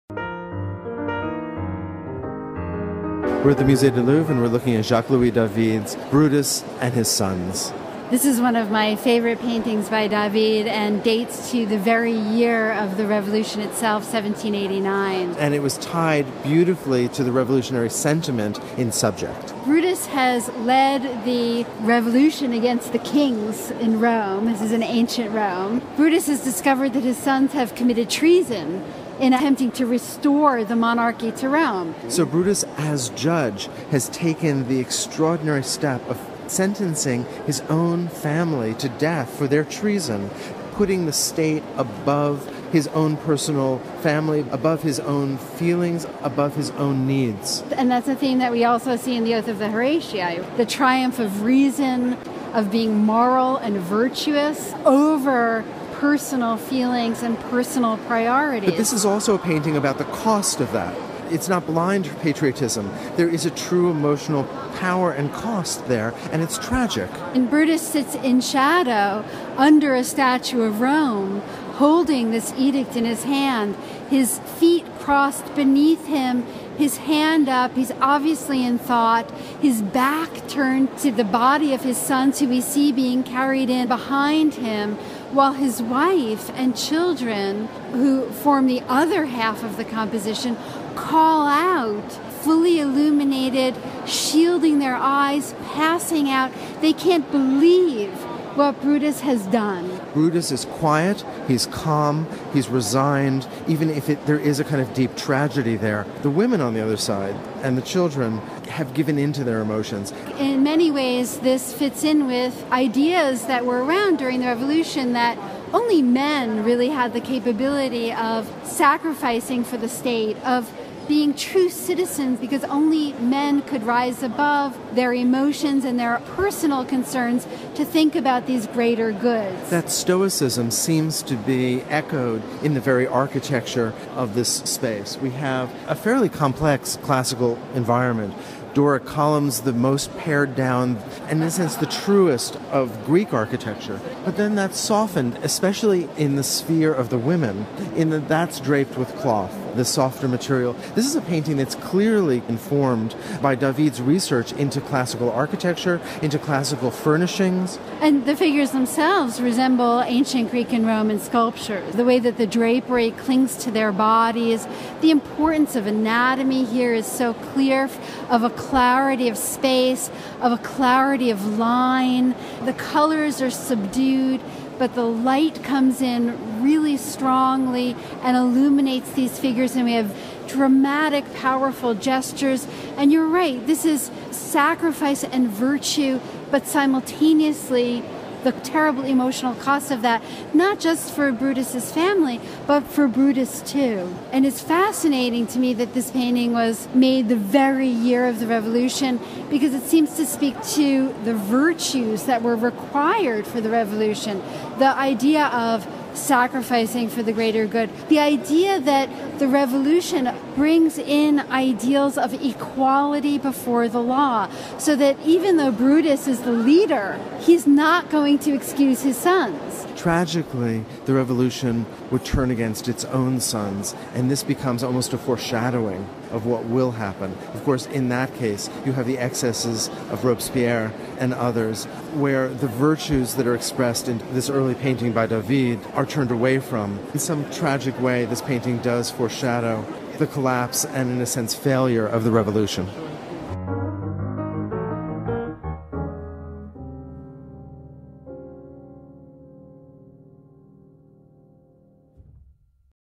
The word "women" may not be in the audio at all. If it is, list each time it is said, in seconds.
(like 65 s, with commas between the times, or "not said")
106 s, 147 s.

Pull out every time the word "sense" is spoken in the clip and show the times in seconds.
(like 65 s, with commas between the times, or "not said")
141 s, 241 s.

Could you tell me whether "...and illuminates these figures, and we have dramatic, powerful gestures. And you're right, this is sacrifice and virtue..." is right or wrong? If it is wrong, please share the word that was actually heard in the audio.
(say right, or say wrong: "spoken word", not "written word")
right.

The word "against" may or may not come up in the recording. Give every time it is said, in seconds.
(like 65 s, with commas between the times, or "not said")
22 s, 222 s.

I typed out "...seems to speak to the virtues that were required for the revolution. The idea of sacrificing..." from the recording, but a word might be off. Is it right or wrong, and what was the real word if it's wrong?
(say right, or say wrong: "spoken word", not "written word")
right.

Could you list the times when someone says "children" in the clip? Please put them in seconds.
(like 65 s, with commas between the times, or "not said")
86 s, 107 s.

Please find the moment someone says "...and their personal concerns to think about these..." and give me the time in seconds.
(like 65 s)
125 s.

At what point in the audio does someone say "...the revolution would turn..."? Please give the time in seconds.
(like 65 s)
221 s.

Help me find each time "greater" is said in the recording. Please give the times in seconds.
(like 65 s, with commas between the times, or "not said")
128 s, 207 s.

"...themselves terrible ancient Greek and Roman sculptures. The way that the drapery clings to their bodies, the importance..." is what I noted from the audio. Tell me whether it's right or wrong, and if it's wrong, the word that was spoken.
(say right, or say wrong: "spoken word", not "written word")
wrong: "resemble", not "terrible".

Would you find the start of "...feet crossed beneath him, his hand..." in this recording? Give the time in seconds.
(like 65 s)
74 s.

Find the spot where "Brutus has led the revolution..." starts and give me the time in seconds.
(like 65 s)
19 s.